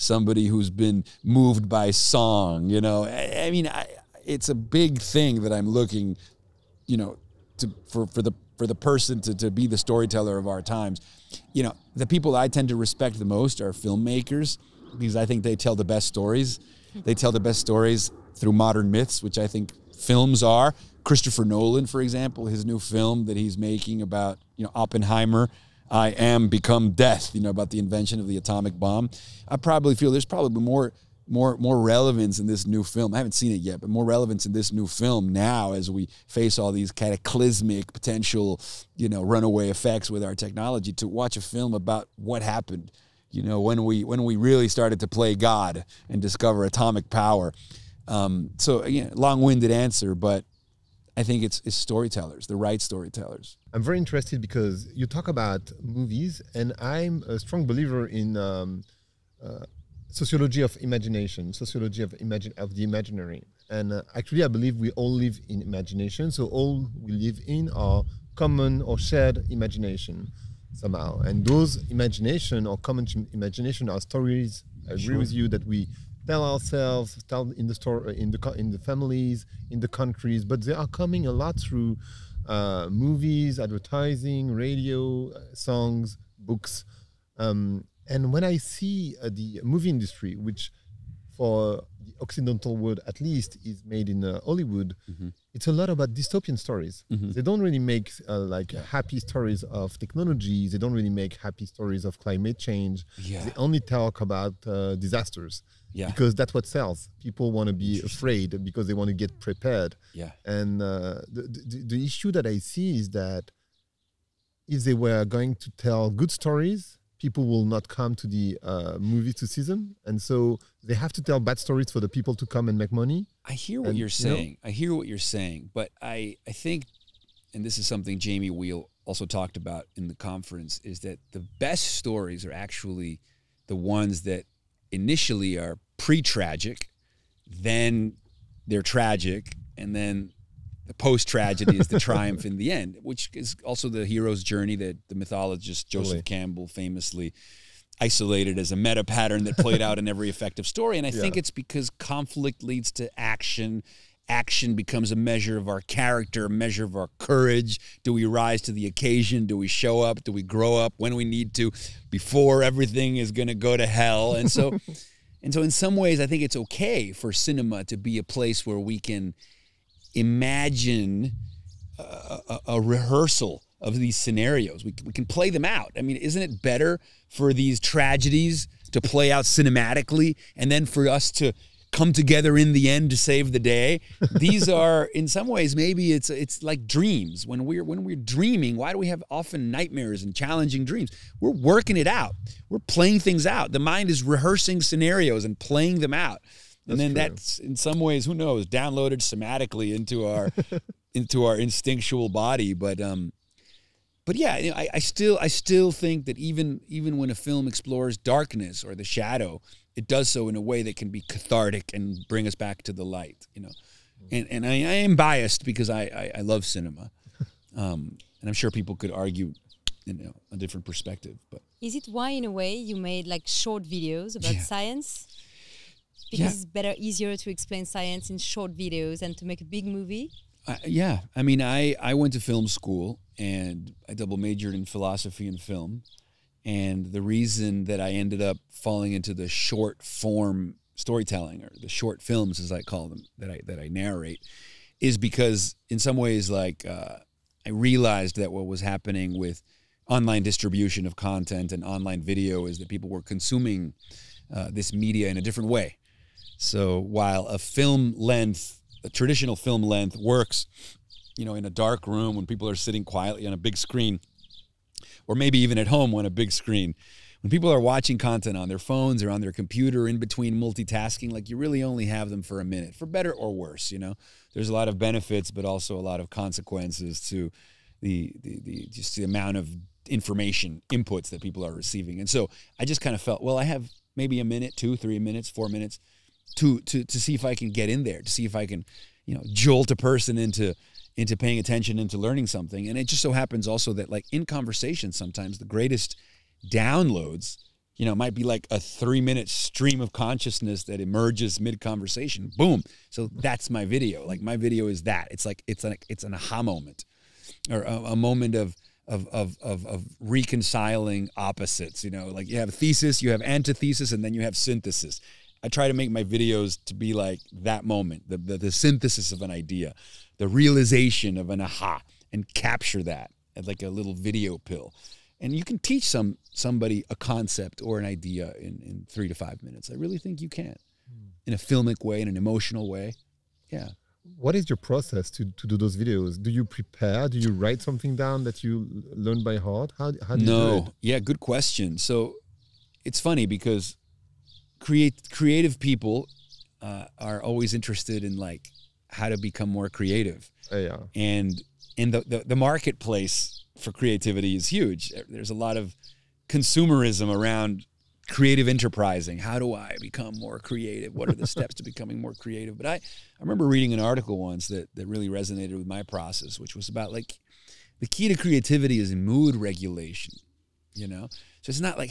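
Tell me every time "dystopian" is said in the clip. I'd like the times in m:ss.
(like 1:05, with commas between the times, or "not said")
1:36.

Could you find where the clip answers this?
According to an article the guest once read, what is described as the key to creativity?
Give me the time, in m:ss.
6:09.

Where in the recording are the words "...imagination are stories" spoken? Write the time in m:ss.
1:13.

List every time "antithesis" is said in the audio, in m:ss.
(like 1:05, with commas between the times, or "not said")
5:13.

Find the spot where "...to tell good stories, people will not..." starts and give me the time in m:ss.
1:55.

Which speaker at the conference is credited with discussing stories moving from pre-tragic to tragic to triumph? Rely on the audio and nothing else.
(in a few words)
Jamie Wheal.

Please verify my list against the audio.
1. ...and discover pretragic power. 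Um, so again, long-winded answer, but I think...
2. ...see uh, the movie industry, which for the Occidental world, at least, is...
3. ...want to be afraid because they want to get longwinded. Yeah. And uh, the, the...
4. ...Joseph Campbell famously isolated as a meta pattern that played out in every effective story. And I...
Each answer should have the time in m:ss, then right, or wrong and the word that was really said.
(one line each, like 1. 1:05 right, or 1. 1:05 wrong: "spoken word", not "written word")
1. 0:46 wrong: "atomic", not "pretragic"
2. 1:28 right
3. 1:47 wrong: "prepared", not "longwinded"
4. 2:25 right.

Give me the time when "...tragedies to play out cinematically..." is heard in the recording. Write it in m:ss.
2:57.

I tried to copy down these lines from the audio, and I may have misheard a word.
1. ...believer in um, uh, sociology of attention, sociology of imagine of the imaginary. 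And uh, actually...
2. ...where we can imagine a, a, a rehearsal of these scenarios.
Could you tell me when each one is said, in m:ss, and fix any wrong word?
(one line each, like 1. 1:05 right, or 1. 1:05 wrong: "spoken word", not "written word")
1. 0:57 wrong: "imagination", not "attention"
2. 2:48 right.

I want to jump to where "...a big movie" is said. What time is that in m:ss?
3:49.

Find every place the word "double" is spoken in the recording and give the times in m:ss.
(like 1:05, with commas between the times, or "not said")
3:54.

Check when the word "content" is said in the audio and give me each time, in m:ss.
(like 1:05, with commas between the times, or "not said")
4:11, 4:28.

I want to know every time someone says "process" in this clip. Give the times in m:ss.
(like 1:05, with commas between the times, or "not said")
5:34, 6:06.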